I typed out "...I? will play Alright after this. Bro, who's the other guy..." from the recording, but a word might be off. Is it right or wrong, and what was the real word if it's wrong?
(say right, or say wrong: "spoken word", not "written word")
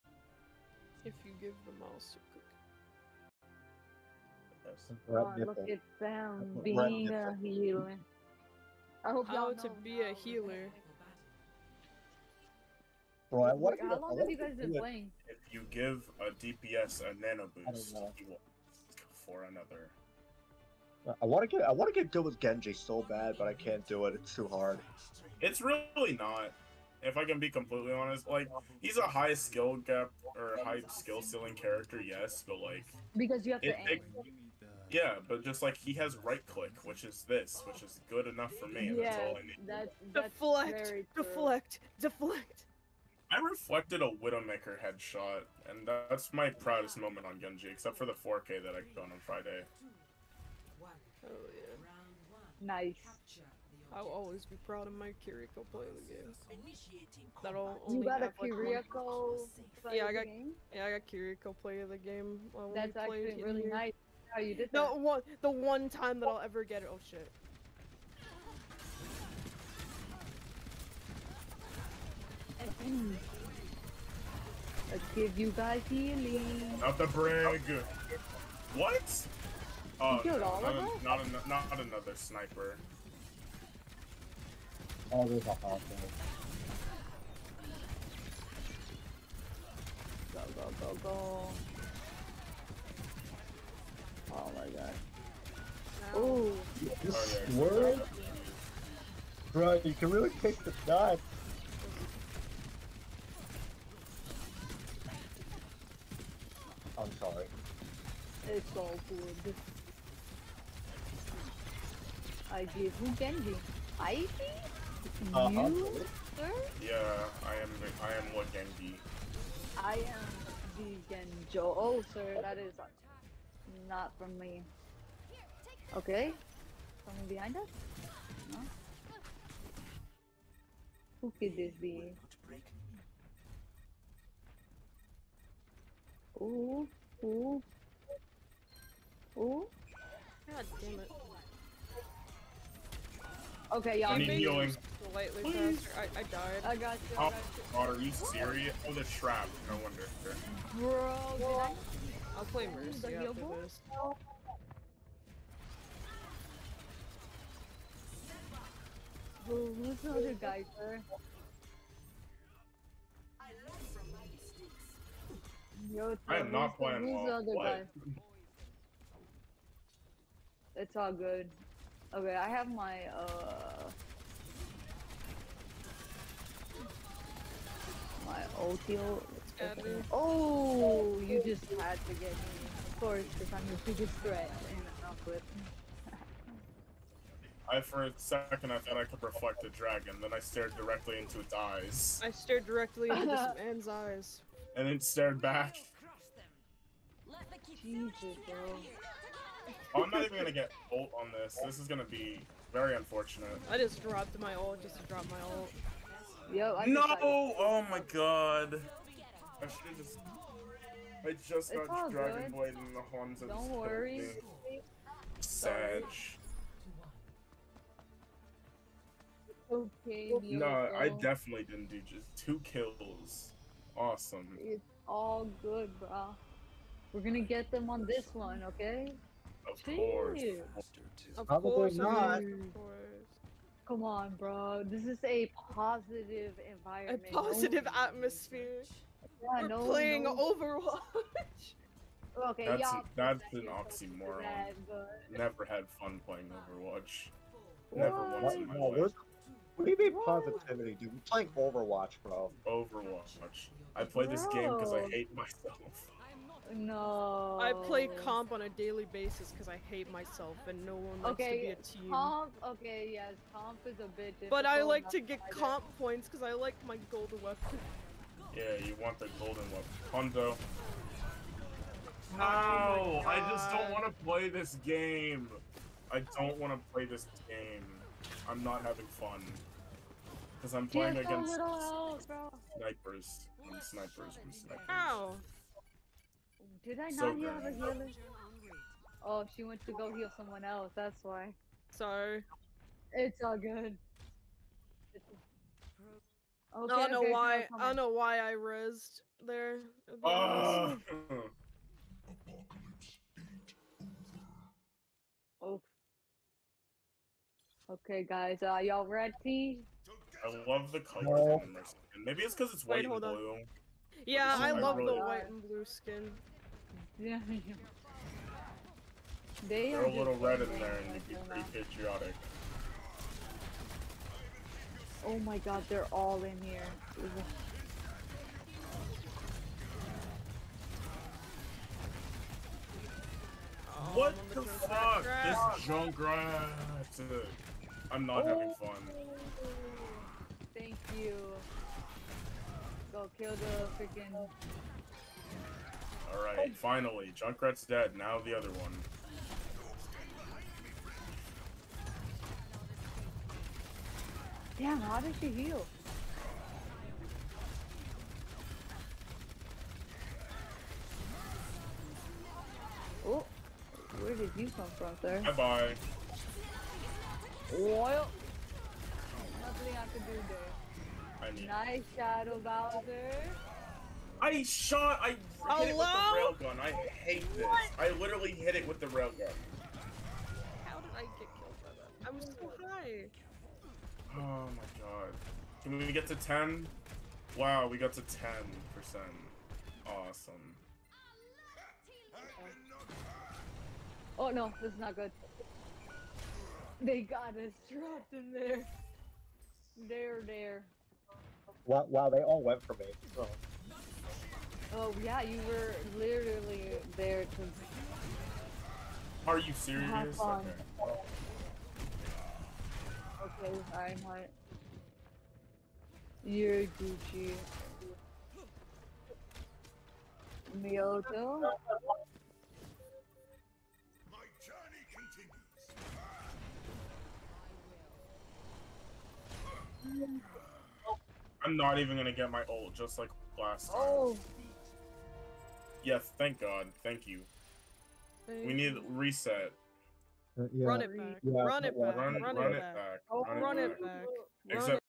wrong: "Mercy", not "Alright".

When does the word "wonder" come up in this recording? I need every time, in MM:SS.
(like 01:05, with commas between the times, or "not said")
00:13, 02:29.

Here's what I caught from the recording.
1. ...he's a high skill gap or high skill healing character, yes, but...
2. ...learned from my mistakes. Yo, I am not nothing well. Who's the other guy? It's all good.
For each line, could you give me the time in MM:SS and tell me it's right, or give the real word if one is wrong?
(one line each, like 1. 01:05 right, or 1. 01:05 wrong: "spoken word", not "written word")
1. 00:28 wrong: "ceiling", not "healing"
2. 02:43 wrong: "playing", not "nothing".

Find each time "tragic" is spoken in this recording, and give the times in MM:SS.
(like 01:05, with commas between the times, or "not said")
not said.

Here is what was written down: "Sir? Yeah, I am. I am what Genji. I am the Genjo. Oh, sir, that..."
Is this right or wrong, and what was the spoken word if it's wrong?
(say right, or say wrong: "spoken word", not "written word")
right.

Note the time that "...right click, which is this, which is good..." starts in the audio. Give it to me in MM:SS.
00:36.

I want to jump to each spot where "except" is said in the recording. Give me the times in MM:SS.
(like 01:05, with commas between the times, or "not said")
00:47, 07:24.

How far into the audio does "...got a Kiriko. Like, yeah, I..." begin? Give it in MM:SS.
00:58.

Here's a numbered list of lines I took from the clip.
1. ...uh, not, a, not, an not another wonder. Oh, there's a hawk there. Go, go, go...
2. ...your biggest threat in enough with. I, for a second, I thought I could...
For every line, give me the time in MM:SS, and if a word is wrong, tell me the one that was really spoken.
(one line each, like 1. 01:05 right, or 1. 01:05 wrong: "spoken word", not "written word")
1. 01:20 wrong: "sniper", not "wonder"
2. 03:03 right.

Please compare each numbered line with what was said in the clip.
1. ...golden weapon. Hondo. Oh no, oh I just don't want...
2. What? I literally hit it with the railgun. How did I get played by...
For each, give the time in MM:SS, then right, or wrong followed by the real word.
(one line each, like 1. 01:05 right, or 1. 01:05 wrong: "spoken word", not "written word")
1. 04:29 right
2. 06:17 wrong: "killed", not "played".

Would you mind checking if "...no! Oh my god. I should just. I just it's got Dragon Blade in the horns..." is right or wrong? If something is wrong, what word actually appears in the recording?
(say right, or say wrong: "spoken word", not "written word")
right.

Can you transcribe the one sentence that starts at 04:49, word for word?
Oh, she went to go heal someone else.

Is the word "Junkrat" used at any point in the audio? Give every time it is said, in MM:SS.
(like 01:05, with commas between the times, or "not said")
05:35, 05:47.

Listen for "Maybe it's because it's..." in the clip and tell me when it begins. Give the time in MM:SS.
05:12.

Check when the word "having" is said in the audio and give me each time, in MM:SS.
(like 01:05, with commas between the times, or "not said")
04:38, 05:38.